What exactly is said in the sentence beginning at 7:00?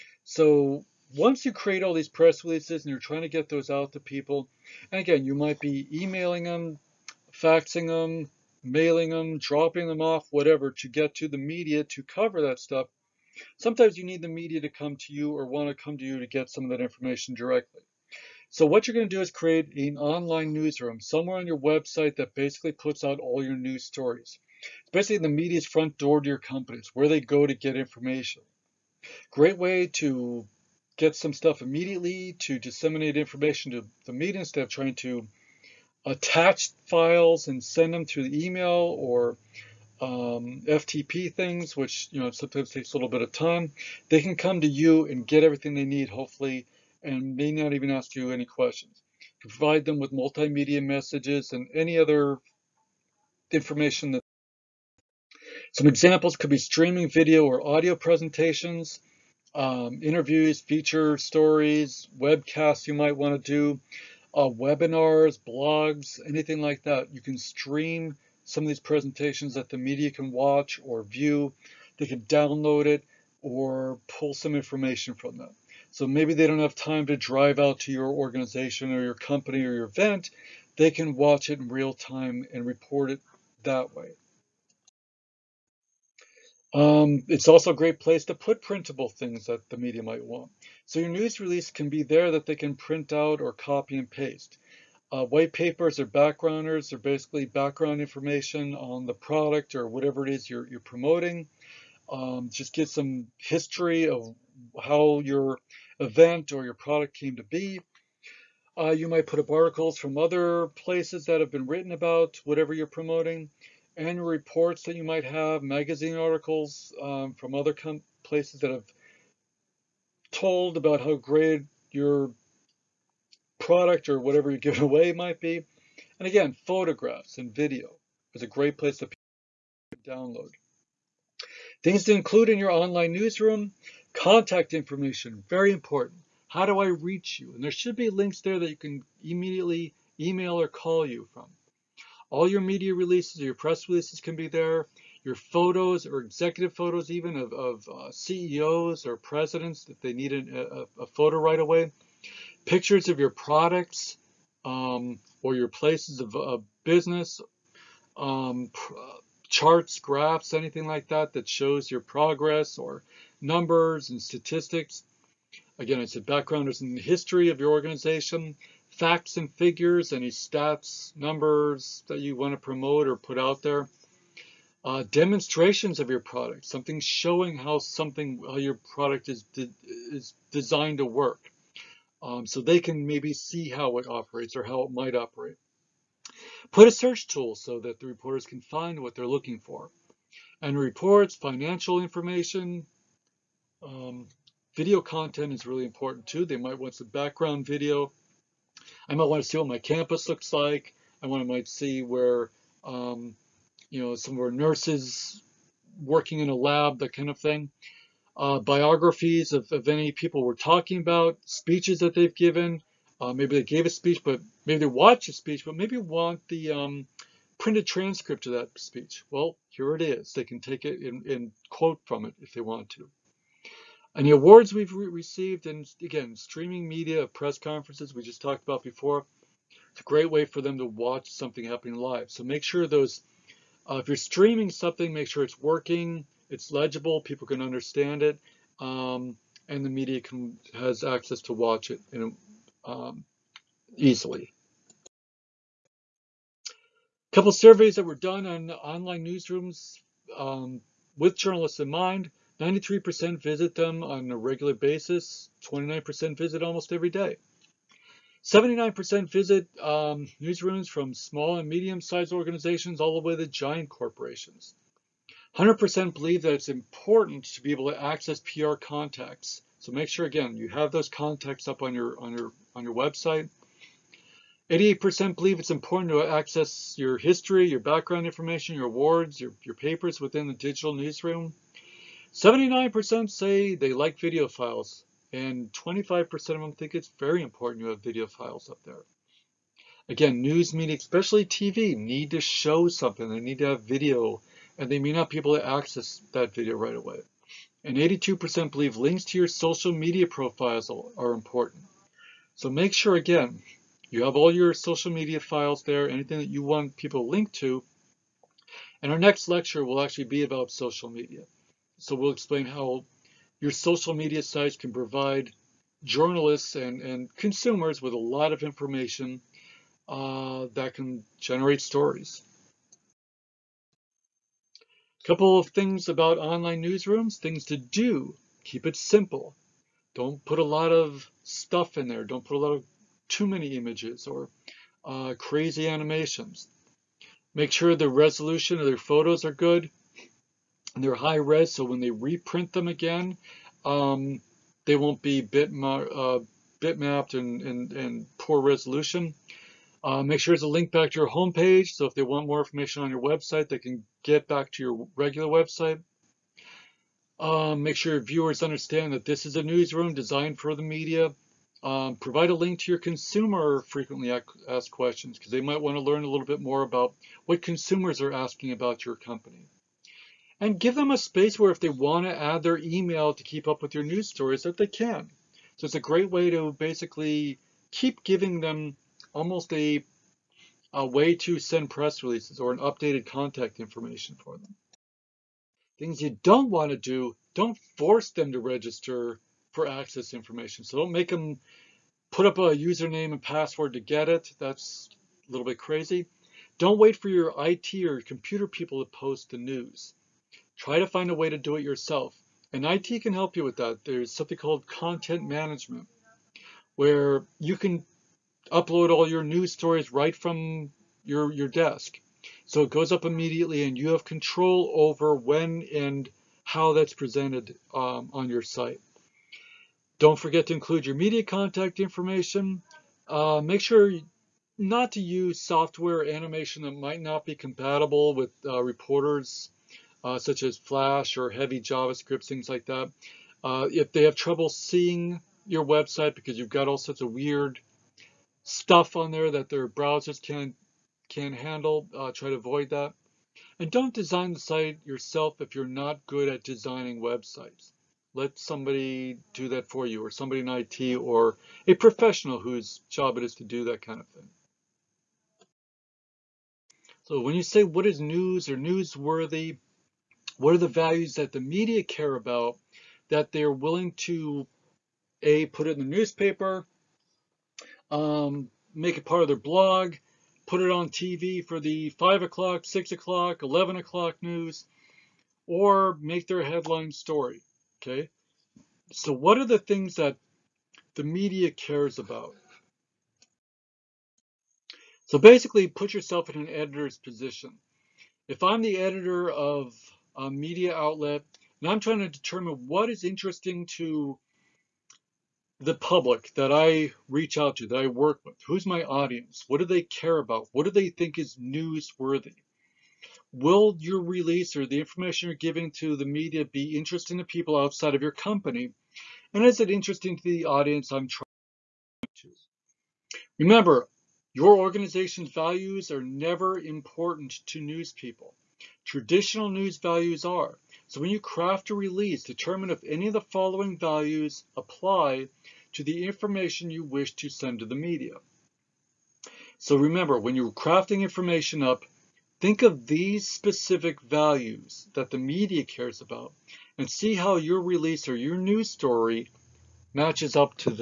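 Don't forget to include your media contact information.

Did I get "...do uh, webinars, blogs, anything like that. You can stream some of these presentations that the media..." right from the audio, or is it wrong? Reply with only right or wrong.
right.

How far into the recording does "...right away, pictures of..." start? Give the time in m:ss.
2:31.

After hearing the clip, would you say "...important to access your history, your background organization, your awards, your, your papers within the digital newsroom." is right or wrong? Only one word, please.
wrong.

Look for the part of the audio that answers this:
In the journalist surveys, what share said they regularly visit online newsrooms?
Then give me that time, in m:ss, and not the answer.
4:12.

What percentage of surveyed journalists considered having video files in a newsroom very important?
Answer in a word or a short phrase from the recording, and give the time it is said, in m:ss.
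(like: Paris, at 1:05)
25%, at 4:45.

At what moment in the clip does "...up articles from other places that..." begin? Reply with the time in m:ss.
1:49.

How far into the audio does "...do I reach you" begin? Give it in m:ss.
2:16.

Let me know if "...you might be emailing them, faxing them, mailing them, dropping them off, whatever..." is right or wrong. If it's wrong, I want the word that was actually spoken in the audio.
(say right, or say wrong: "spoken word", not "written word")
right.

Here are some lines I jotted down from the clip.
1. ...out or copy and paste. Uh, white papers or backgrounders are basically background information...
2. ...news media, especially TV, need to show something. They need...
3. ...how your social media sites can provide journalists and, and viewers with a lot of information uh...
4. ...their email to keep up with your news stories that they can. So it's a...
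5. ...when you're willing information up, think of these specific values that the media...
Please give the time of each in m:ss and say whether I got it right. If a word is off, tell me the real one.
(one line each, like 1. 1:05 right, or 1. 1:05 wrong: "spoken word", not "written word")
1. 1:33 right
2. 4:50 right
3. 5:12 wrong: "consumers", not "viewers"
4. 6:12 right
5. 8:50 wrong: "crafting", not "willing".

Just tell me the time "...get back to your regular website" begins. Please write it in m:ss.
5:54.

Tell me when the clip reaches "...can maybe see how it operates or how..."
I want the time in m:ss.
3:02.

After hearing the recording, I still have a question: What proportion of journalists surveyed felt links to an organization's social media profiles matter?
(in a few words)
82%.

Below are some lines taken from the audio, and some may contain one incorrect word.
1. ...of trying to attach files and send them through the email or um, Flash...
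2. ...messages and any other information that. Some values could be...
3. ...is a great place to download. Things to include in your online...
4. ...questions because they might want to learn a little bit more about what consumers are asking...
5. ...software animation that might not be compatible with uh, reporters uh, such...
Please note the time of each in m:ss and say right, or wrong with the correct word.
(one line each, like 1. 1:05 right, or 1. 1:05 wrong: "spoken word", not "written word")
1. 0:34 wrong: "FTP", not "Flash"
2. 0:50 wrong: "examples", not "values"
3. 2:08 right
4. 6:04 right
5. 7:05 right.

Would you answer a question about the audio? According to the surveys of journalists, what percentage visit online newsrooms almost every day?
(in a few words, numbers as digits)
29%.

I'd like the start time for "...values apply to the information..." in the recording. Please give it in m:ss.
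8:43.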